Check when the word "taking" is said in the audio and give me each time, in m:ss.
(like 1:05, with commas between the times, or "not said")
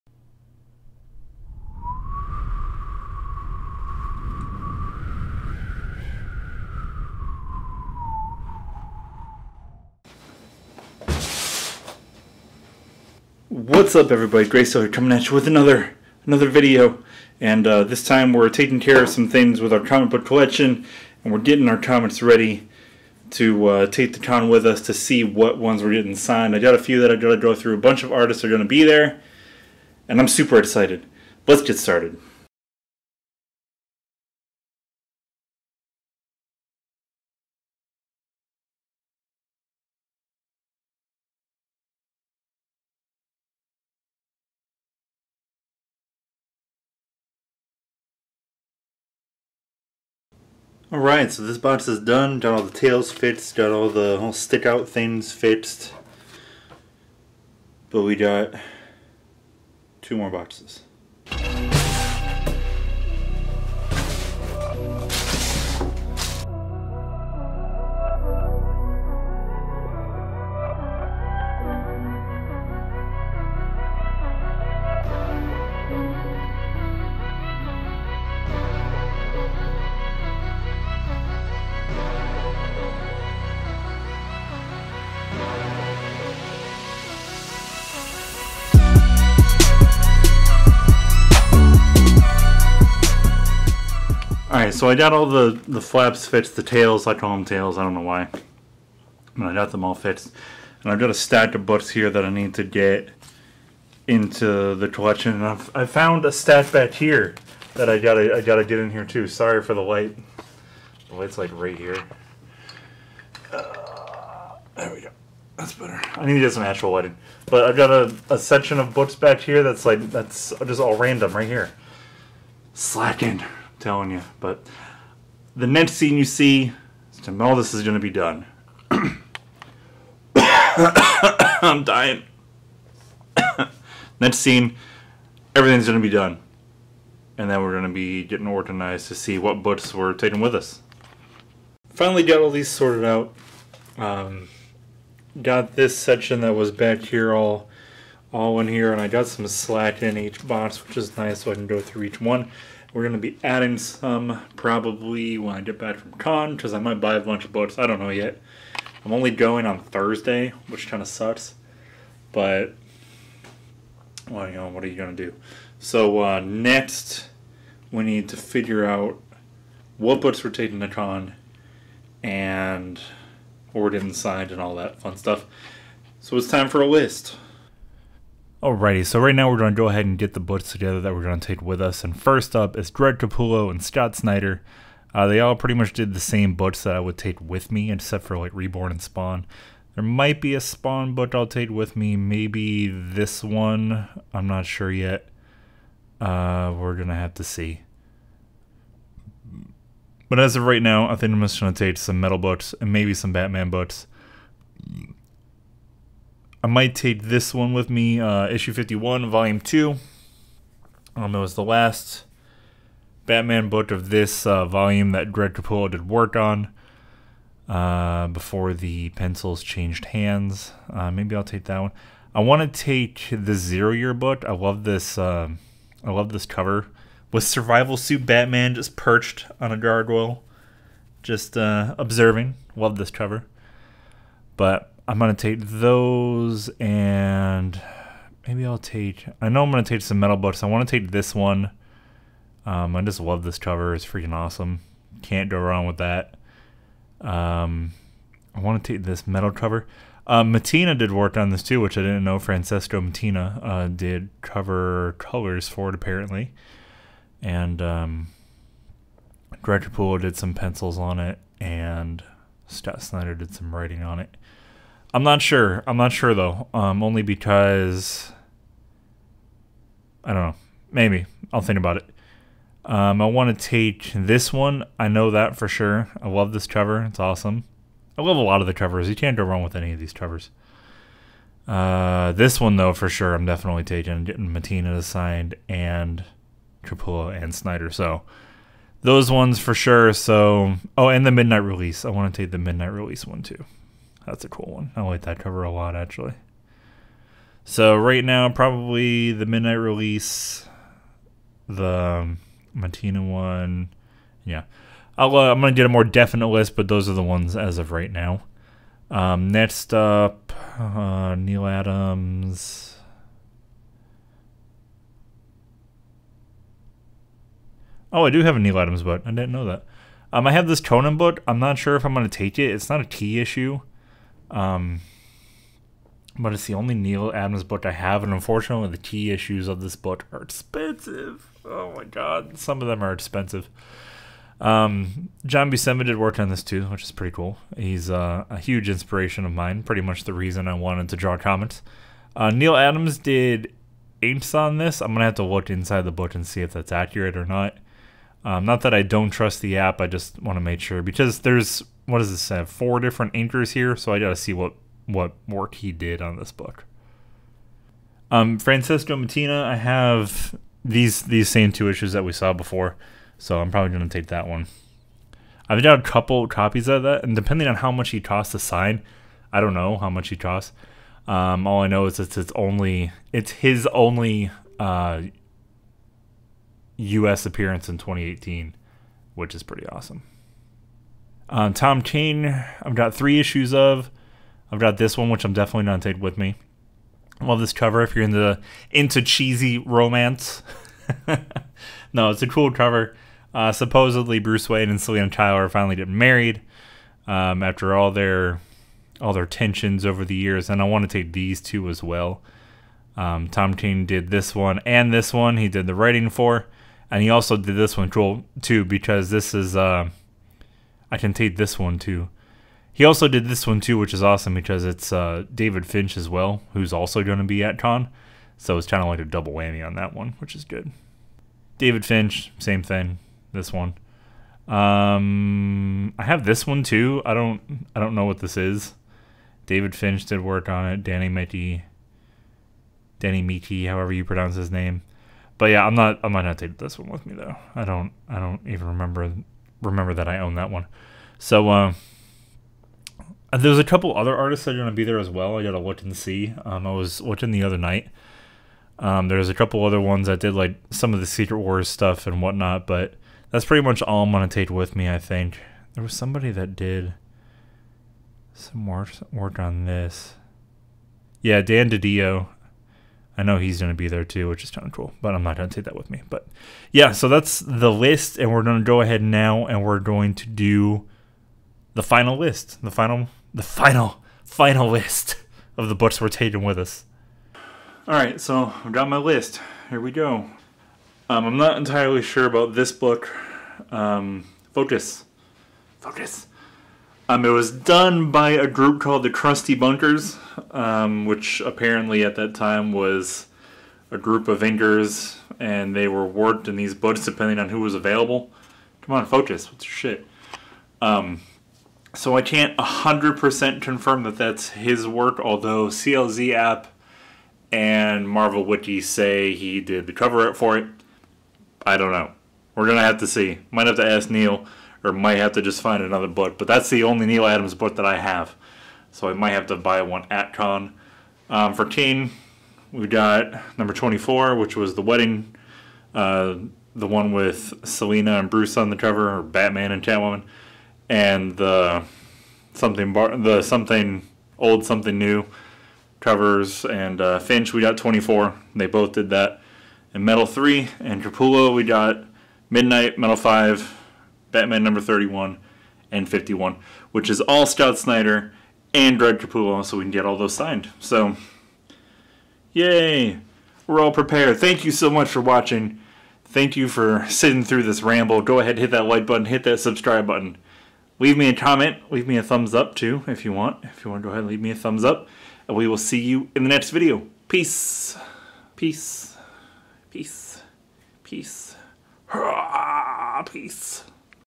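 0:18, 2:20, 2:50, 4:43, 6:26, 7:56.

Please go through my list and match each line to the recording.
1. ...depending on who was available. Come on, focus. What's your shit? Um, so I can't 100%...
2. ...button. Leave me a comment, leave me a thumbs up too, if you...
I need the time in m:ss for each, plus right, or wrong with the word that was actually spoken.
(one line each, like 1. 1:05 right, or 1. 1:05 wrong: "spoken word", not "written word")
1. 8:17 right
2. 9:20 right.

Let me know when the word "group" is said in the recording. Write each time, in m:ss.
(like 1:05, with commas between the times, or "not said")
8:08, 8:14.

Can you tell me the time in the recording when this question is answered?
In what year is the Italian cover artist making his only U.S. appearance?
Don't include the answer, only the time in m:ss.
6:17.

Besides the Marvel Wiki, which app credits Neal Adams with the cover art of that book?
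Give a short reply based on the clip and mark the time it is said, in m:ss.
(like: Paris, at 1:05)
CLZ, at 8:25.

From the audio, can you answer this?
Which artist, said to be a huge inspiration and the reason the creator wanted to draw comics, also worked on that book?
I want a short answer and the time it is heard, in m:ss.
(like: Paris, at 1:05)
John Buscema, at 5:35.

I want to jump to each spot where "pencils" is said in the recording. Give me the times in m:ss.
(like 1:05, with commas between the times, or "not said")
3:39, 4:20.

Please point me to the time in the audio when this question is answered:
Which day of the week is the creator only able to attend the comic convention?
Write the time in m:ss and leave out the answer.
2:39.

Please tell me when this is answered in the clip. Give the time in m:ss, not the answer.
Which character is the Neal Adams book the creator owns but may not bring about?
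5:20.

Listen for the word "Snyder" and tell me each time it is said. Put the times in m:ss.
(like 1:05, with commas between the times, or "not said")
3:04, 4:23, 4:47, 9:07.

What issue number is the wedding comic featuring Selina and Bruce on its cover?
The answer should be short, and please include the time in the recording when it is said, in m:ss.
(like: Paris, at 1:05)
24, at 8:43.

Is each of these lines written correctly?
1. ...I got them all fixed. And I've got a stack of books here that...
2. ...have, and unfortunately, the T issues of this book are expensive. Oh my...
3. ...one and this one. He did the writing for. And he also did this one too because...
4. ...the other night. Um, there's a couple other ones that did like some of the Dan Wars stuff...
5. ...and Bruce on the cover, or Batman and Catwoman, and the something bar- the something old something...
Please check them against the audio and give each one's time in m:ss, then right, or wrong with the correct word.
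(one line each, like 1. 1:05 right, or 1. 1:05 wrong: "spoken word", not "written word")
1. 1:39 right
2. 5:27 right
3. 6:44 right
4. 7:27 wrong: "Secret", not "Dan"
5. 8:48 right.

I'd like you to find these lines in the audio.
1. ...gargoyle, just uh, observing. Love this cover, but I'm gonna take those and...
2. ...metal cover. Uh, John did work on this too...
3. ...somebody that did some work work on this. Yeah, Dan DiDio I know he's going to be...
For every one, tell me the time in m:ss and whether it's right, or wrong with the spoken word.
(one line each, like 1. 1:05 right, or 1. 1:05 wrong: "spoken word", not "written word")
1. 3:49 right
2. 4:09 wrong: "Mattina", not "John"
3. 7:36 right.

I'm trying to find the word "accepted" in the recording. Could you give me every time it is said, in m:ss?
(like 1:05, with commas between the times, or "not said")
not said.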